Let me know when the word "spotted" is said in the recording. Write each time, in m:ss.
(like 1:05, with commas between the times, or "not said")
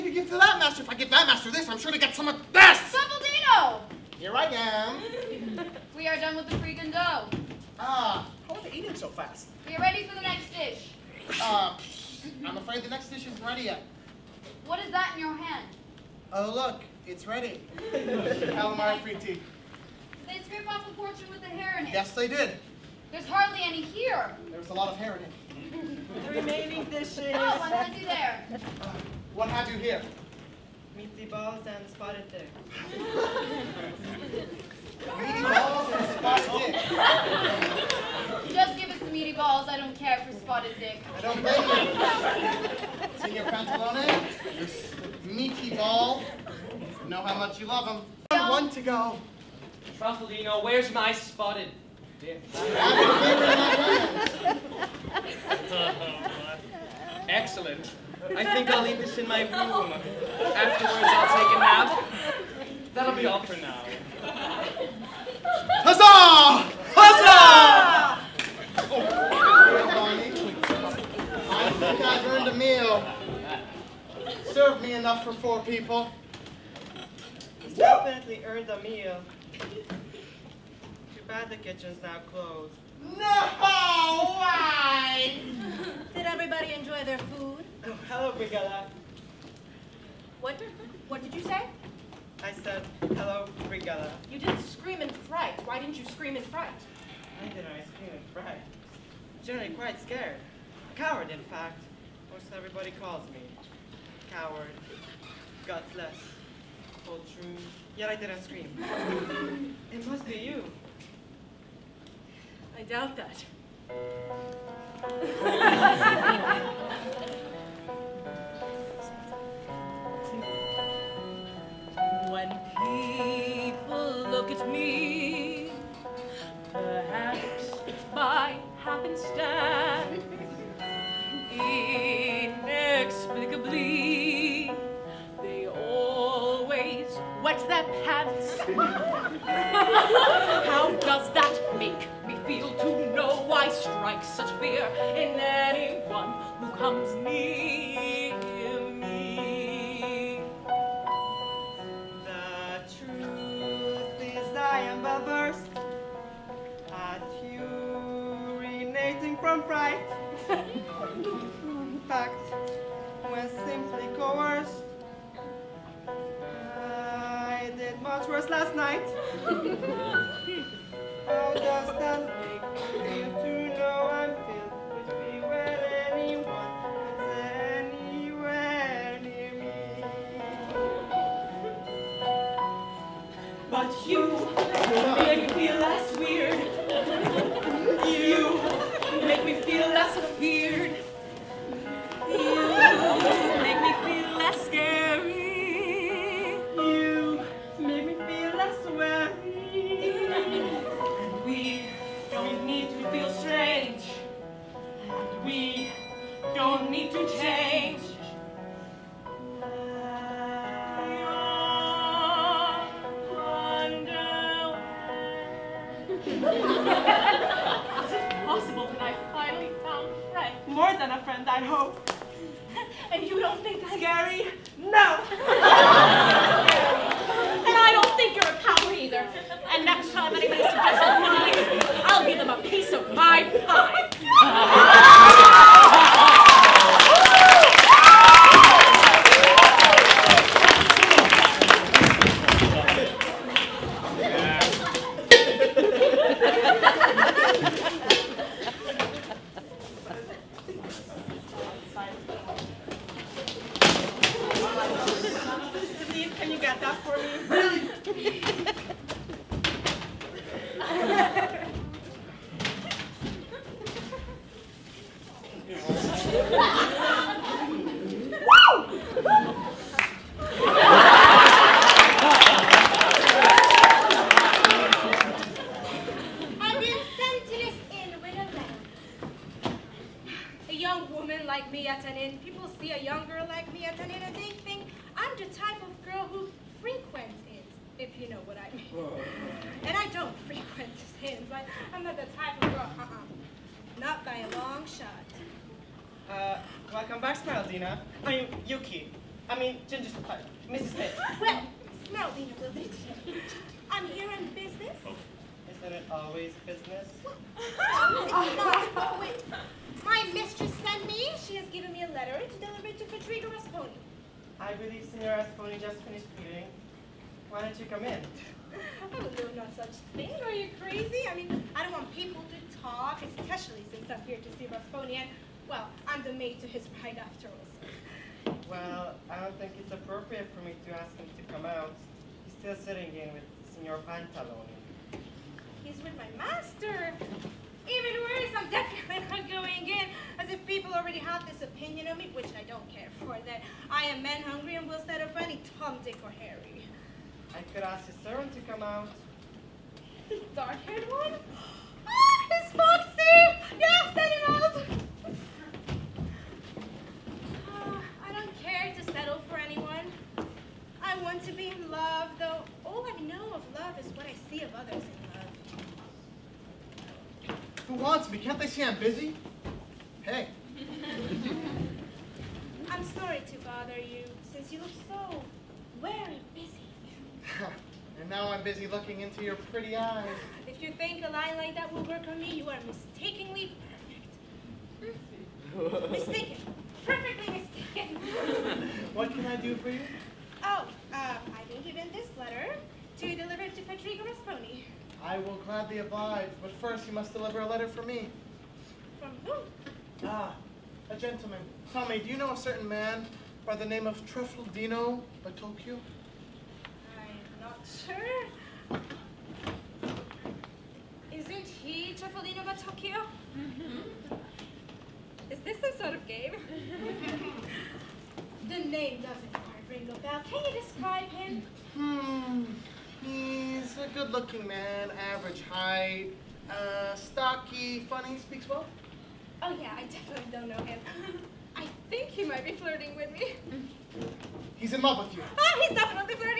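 0:31, 0:36, 0:40, 0:51.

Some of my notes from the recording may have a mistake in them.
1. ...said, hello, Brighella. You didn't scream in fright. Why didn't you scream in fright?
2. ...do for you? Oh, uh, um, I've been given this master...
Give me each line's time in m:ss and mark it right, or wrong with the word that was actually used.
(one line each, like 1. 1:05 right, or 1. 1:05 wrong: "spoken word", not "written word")
1. 1:32 right
2. 6:29 wrong: "letter", not "master".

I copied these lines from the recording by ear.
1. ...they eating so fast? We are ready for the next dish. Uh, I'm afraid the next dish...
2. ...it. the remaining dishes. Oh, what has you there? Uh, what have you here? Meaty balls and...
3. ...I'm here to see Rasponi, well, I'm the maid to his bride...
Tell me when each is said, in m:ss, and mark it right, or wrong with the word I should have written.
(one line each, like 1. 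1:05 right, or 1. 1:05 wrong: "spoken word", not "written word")
1. 0:08 right
2. 0:25 right
3. 5:24 right.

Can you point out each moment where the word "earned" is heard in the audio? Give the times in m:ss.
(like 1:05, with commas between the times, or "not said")
1:12, 1:18.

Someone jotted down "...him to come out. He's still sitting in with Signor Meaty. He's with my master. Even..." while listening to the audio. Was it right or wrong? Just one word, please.
wrong.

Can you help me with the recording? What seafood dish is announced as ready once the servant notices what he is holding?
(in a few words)
Calamari.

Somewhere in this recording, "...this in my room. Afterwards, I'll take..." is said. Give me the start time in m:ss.
0:58.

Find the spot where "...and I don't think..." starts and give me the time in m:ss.
3:47.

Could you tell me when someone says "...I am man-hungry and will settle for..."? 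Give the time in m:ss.
5:43.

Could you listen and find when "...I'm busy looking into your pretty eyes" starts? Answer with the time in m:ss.
6:18.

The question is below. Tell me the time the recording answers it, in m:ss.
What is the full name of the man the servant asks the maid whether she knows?
6:44.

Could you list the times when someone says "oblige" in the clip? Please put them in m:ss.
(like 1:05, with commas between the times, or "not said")
6:35.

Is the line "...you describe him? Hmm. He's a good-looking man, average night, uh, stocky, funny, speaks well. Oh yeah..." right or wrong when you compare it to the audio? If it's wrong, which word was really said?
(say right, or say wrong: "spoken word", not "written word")
wrong: "height", not "night".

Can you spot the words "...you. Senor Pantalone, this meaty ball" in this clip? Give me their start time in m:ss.
0:43.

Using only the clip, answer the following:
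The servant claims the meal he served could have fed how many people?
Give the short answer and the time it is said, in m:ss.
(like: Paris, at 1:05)
4, at 1:15.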